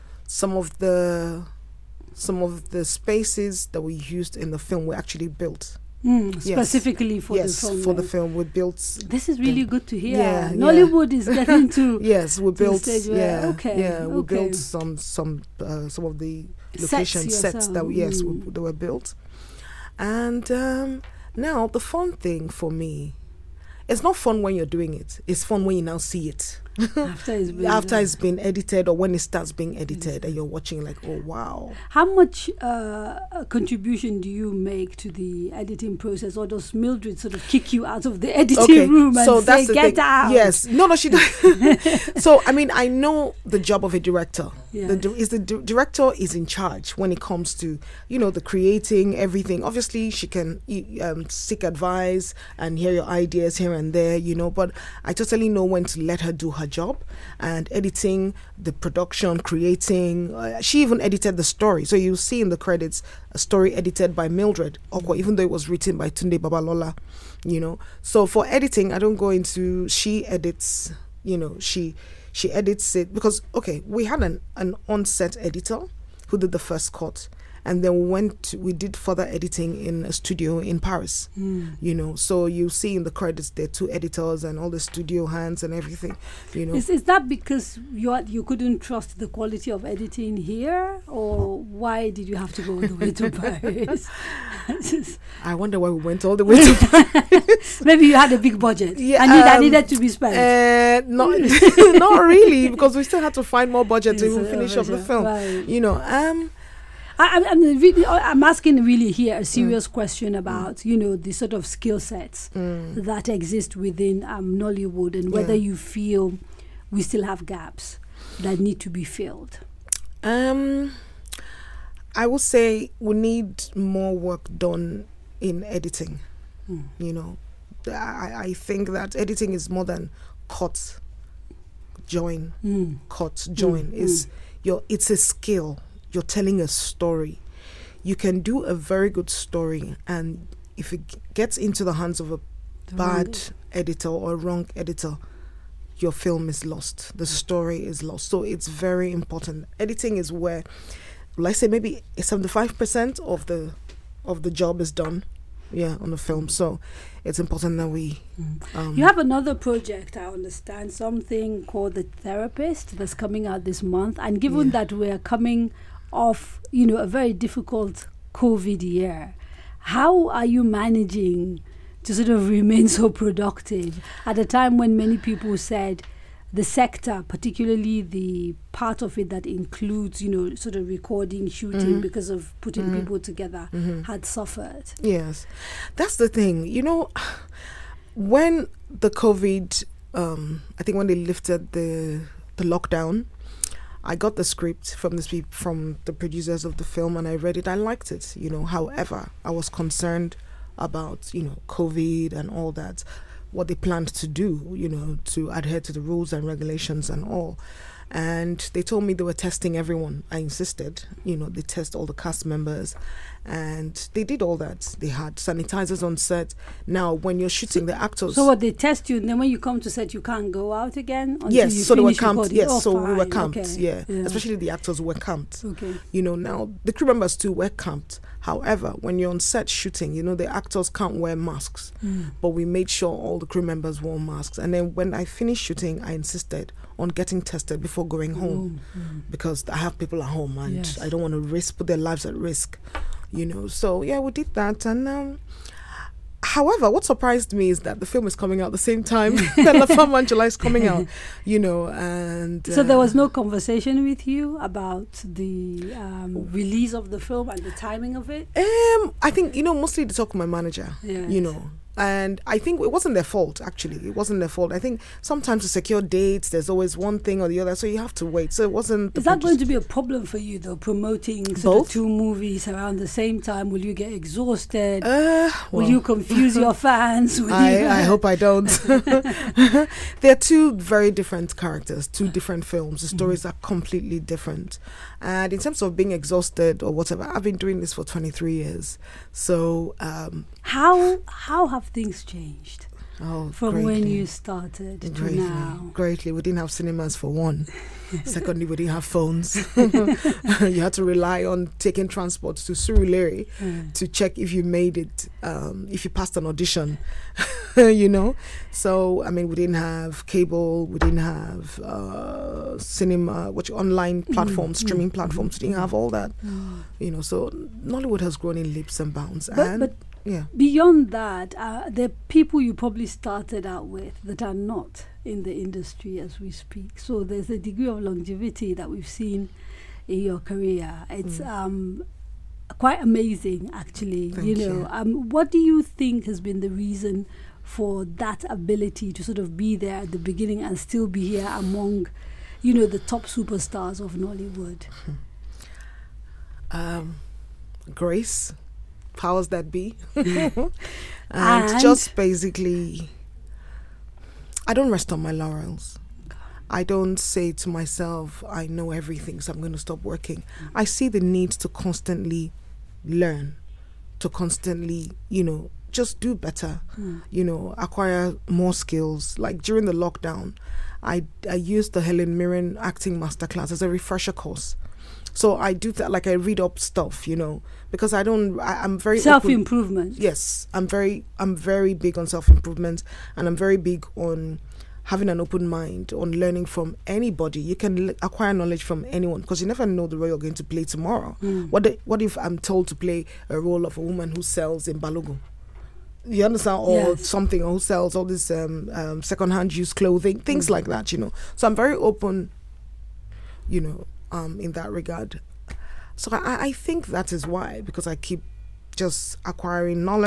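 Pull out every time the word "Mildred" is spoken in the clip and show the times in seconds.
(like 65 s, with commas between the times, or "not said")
36 s, 64 s.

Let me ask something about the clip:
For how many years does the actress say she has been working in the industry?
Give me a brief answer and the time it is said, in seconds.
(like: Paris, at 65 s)
23, at 288 s.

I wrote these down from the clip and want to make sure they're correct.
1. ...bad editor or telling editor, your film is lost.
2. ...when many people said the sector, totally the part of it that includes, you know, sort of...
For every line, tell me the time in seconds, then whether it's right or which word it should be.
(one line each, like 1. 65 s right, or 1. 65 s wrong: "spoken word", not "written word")
1. 142 s wrong: "wrong", not "telling"
2. 174 s wrong: "particularly", not "totally".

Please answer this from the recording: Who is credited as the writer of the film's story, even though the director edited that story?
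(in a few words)
Tunde Babalola.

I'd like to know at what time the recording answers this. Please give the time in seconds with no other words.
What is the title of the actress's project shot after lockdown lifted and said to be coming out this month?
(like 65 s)
161 s.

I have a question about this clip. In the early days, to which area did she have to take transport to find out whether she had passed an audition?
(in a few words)
Surulere.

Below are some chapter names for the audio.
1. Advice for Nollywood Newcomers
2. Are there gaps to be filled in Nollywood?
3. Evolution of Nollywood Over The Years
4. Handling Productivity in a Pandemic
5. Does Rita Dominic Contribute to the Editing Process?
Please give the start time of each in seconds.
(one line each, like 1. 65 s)
1. 357 s
2. 109 s
3. 279 s
4. 158 s
5. 31 s.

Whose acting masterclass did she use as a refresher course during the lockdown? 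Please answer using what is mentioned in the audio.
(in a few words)
Helen Mirren.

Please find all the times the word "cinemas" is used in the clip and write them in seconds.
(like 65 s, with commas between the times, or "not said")
296 s, 312 s.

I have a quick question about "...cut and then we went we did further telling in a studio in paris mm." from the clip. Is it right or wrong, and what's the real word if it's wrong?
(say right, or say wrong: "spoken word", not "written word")
wrong: "editing", not "telling".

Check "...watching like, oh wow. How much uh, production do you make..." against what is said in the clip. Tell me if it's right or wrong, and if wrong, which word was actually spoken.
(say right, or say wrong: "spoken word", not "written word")
wrong: "contribution", not "production".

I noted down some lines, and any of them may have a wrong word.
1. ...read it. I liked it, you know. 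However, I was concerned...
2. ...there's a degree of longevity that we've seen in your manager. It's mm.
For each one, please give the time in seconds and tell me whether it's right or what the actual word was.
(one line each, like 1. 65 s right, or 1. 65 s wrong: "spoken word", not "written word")
1. 197 s right
2. 327 s wrong: "career", not "manager".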